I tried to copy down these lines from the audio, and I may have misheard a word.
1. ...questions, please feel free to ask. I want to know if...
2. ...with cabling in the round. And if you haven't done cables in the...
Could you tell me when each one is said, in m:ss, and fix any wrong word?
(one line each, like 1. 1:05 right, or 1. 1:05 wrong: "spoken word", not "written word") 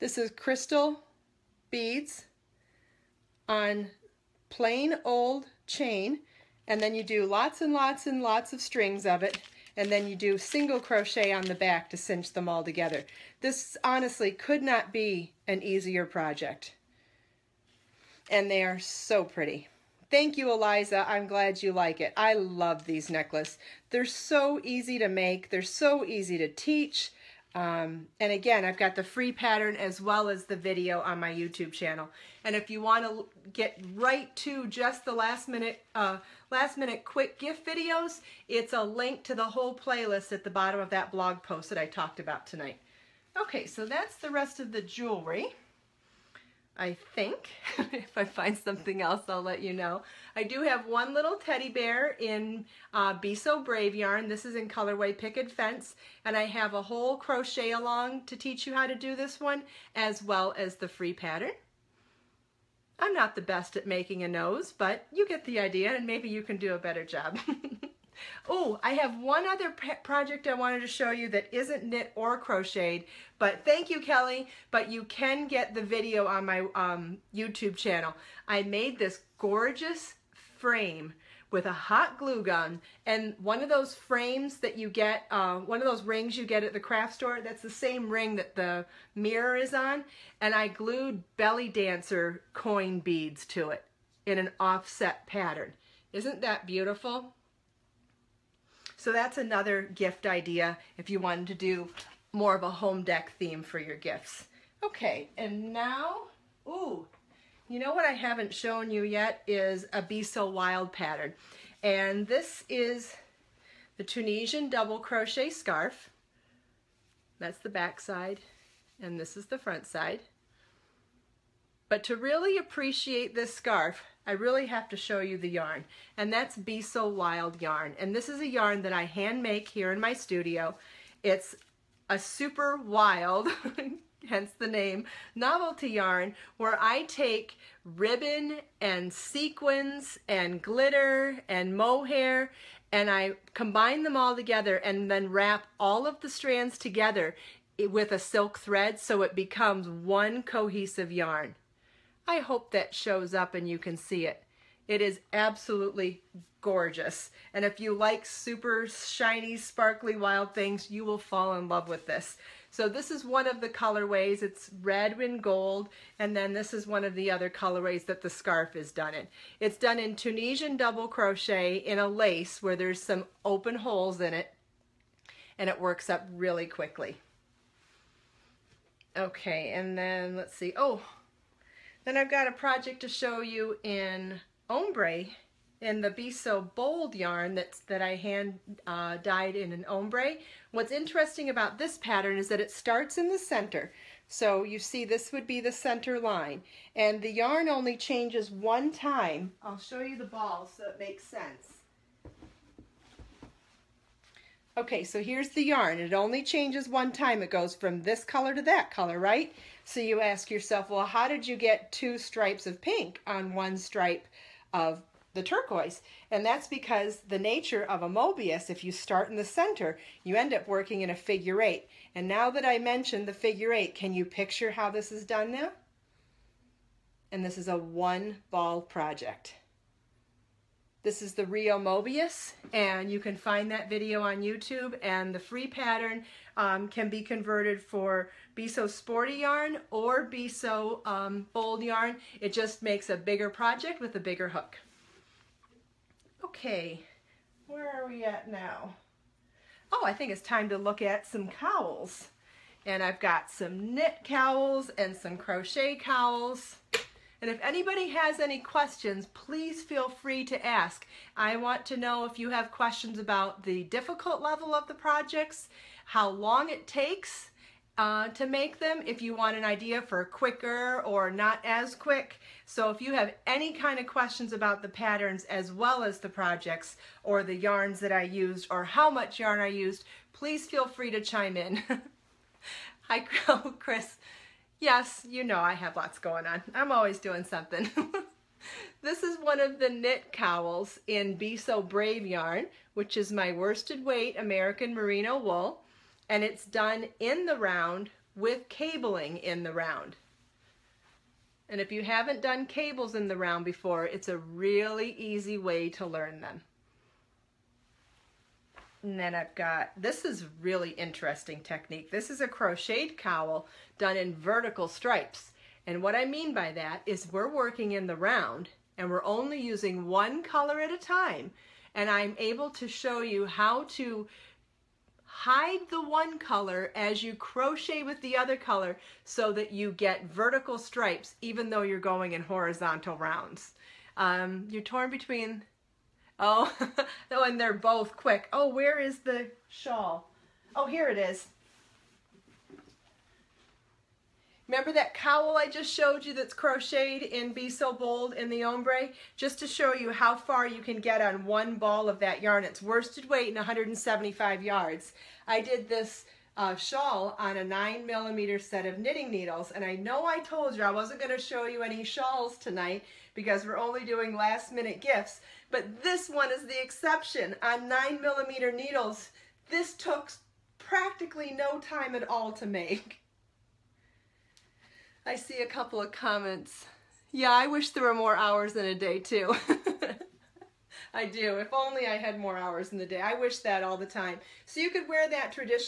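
1. 4:18 right
2. 4:58 right.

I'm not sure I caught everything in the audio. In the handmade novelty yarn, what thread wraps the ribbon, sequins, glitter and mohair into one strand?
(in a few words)
silk thread.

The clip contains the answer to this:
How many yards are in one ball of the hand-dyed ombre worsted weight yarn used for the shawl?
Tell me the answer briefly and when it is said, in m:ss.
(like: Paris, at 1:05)
175, at 5:53.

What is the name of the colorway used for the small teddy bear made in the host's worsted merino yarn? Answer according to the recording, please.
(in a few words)
Picket Fence.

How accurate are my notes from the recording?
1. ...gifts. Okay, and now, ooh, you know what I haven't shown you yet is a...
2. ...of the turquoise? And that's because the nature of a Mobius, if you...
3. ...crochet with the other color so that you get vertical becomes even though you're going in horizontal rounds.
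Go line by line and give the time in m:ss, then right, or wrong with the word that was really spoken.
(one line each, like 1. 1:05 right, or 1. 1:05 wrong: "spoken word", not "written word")
1. 1:43 right
2. 3:34 right
3. 5:27 wrong: "stripes", not "becomes".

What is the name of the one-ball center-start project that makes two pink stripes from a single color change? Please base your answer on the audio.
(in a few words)
Rio Mobius.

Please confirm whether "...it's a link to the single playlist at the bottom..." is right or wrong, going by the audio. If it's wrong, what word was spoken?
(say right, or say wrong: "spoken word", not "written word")
wrong: "whole", not "single".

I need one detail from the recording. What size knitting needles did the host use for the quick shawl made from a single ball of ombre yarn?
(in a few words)
9 millimeter.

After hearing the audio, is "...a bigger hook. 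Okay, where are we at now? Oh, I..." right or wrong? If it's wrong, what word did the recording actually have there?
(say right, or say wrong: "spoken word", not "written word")
right.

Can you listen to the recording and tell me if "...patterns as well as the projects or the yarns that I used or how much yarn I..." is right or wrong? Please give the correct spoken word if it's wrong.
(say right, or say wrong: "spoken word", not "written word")
right.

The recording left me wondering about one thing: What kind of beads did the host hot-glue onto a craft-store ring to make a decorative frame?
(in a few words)
belly dancer coin beads.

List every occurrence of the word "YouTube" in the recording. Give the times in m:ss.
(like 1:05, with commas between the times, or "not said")
0:31, 1:17, 3:54.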